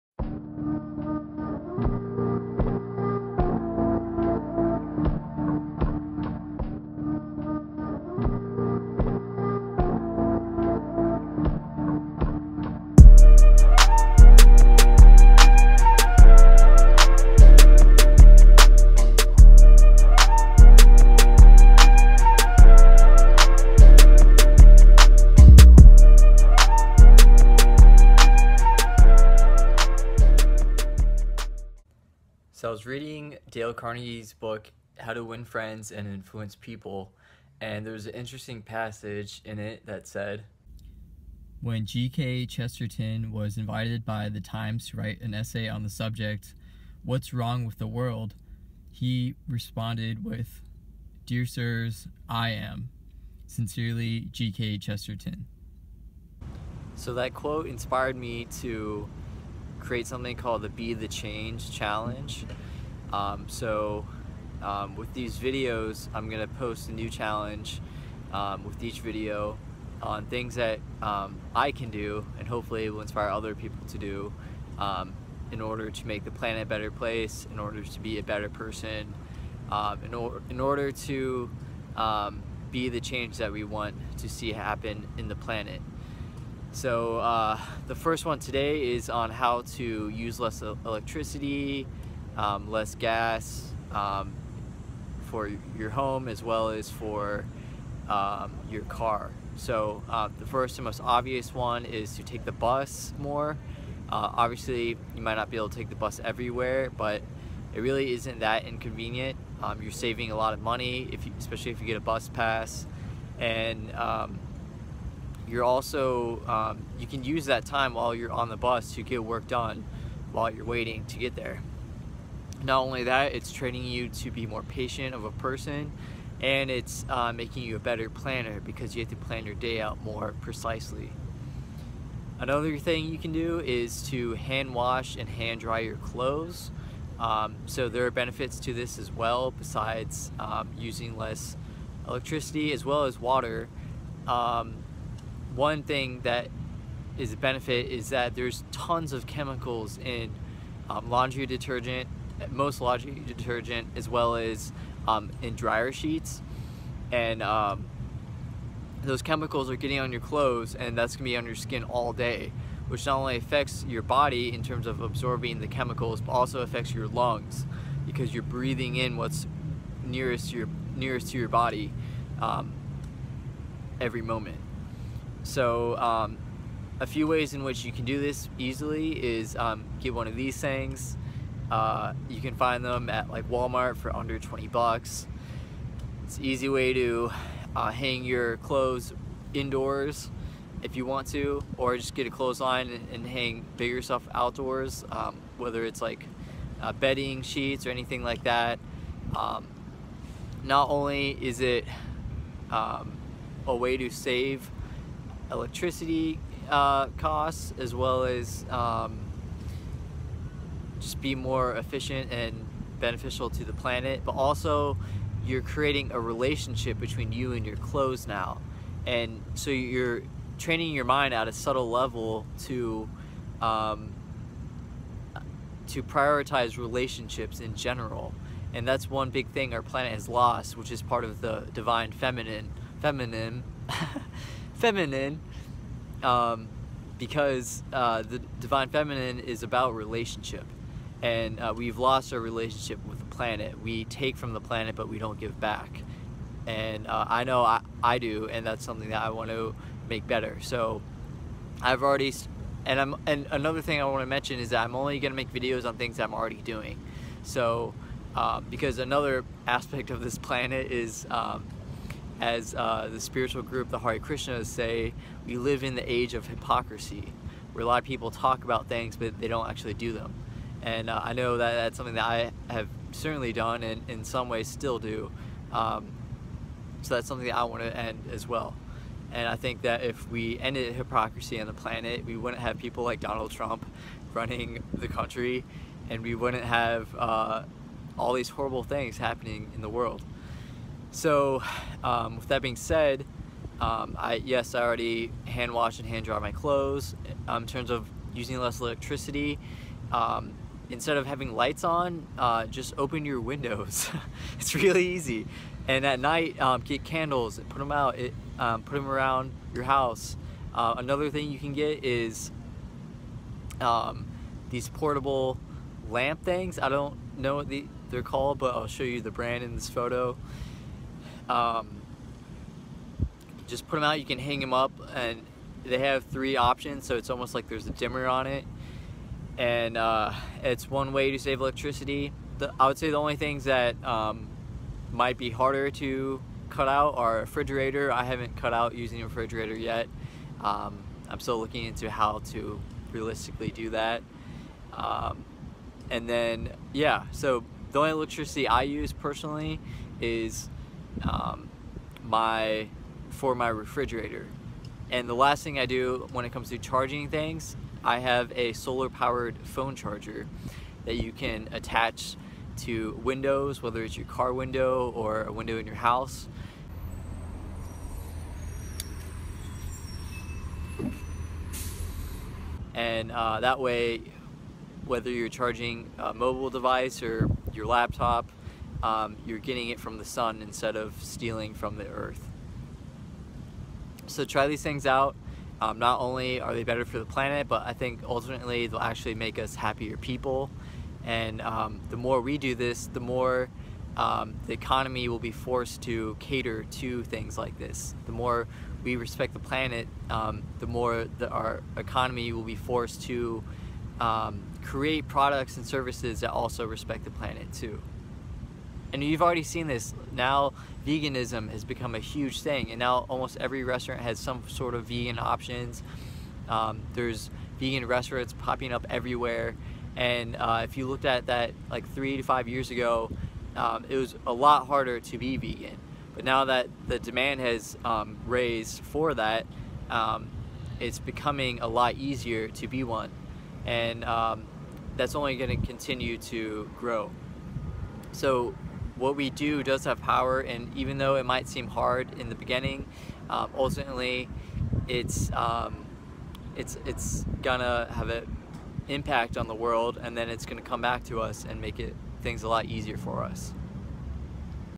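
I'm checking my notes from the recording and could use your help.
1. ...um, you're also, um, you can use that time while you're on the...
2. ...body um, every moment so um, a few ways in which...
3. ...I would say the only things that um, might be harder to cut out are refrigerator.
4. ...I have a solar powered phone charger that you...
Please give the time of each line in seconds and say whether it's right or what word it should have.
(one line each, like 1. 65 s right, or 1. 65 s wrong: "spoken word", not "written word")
1. 113 s right
2. 171 s right
3. 332 s right
4. 358 s right.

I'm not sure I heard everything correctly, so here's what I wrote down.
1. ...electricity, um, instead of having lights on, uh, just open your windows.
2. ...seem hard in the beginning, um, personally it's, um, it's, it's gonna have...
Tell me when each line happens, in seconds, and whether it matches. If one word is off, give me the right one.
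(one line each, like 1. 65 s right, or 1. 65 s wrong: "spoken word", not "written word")
1. 298 s right
2. 441 s wrong: "ultimately", not "personally".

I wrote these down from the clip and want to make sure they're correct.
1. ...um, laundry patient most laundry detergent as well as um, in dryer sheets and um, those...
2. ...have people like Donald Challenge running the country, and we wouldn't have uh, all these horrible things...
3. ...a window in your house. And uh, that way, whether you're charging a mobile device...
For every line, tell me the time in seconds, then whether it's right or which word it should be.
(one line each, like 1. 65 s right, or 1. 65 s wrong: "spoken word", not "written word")
1. 150 s wrong: "detergent", not "patient"
2. 282 s wrong: "Trump", not "Challenge"
3. 365 s right.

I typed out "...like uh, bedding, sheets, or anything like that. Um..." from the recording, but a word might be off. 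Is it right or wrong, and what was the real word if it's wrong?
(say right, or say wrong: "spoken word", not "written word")
right.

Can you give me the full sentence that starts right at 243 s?
We take from the planet, but we don't give back.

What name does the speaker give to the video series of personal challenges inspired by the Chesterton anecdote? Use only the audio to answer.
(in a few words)
Be the Change Challenge.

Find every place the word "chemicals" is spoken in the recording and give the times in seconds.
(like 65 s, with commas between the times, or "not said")
149 s, 159 s, 165 s.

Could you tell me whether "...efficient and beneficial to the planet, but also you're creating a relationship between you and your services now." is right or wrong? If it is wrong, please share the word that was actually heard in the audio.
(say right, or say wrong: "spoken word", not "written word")
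wrong: "clothes", not "services".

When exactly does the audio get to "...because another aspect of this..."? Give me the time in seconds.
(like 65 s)
258 s.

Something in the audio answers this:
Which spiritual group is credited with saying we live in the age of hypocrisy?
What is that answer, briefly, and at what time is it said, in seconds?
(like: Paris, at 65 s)
Hare Krishnas, at 263 s.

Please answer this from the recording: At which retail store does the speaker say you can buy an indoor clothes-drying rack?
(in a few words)
Walmart.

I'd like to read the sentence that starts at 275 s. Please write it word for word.
Um, so that's something that I want to end as well.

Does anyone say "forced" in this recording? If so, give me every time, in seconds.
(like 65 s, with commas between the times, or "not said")
395 s, 402 s.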